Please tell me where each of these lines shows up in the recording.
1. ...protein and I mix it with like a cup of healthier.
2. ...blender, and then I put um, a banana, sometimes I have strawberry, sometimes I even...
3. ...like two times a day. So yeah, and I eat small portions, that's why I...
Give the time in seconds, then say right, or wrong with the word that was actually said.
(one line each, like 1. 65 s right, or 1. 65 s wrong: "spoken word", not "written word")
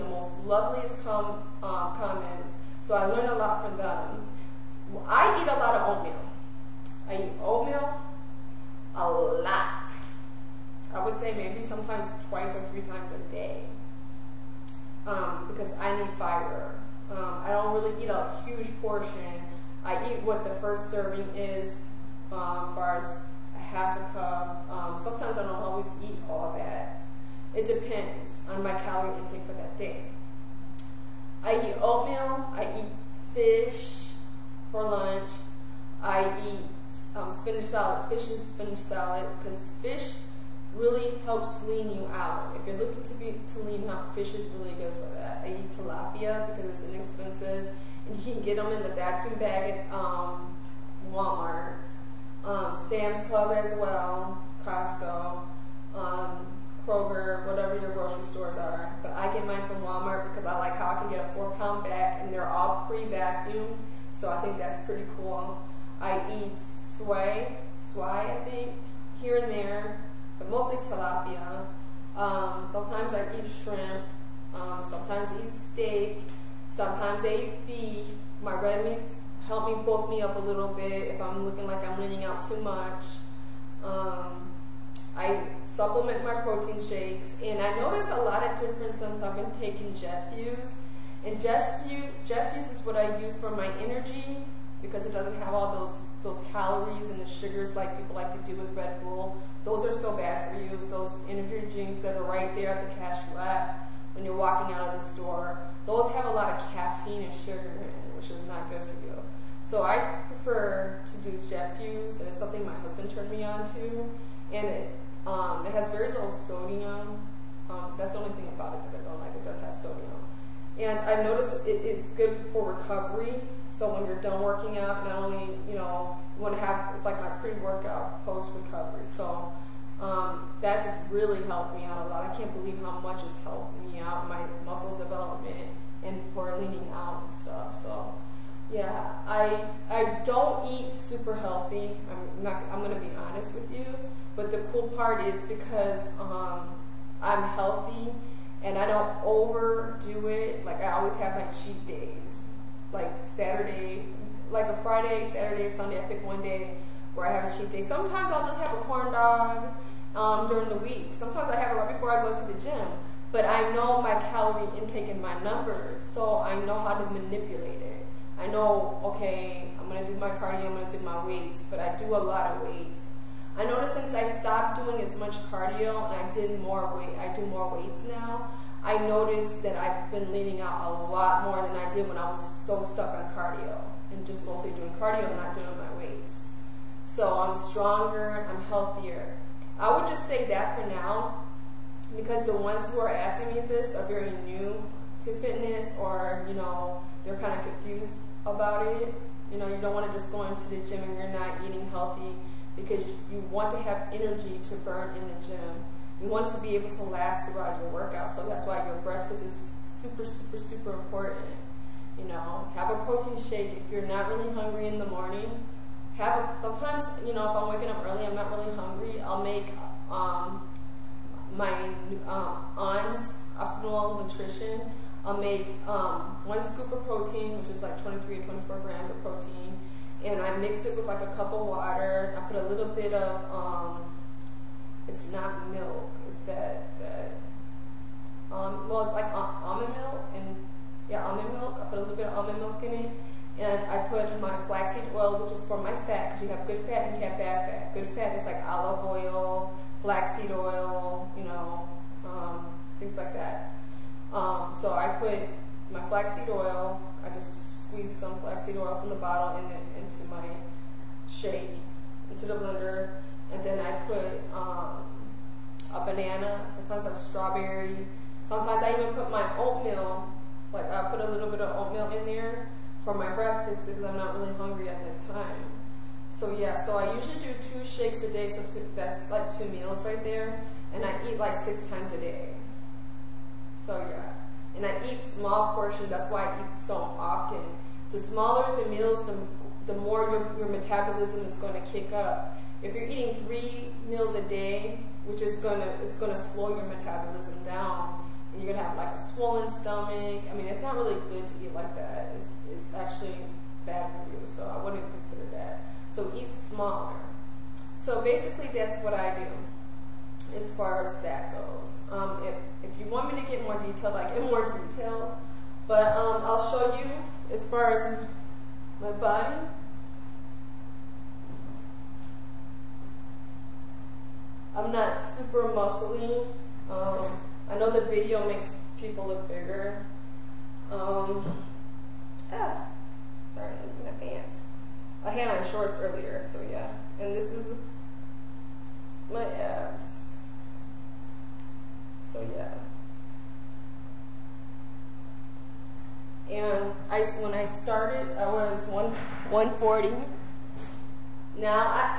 1. 229 s wrong: "water", not "healthier"
2. 262 s right
3. 281 s wrong: "six", not "two".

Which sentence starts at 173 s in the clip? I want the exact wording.
I noticed since I stopped doing as much cardio and I did more weight, I do more weights now.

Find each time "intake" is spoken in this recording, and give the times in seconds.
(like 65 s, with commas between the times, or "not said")
29 s, 164 s.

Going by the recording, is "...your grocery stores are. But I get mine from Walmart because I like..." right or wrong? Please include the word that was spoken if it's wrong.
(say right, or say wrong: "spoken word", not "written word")
right.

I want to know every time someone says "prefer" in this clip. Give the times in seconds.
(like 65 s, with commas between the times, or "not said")
110 s.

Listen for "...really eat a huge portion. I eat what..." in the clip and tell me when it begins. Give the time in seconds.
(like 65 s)
17 s.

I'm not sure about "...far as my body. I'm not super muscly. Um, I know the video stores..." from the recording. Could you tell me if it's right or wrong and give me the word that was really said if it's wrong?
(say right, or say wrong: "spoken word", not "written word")
wrong: "makes", not "stores".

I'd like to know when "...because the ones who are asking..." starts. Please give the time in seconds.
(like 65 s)
192 s.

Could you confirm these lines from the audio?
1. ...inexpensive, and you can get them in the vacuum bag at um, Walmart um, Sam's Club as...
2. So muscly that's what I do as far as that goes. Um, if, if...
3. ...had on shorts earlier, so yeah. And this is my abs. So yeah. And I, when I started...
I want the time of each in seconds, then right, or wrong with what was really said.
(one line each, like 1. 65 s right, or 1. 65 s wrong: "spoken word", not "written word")
1. 46 s right
2. 307 s wrong: "basically", not "muscly"
3. 335 s right.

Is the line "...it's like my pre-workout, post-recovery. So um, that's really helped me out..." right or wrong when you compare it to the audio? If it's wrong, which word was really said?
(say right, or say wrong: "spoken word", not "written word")
right.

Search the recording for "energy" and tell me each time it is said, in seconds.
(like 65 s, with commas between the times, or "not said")
93 s, 101 s, 204 s.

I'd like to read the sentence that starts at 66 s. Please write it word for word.
I eat swai, swai, I think, here and there, but mostly tilapia.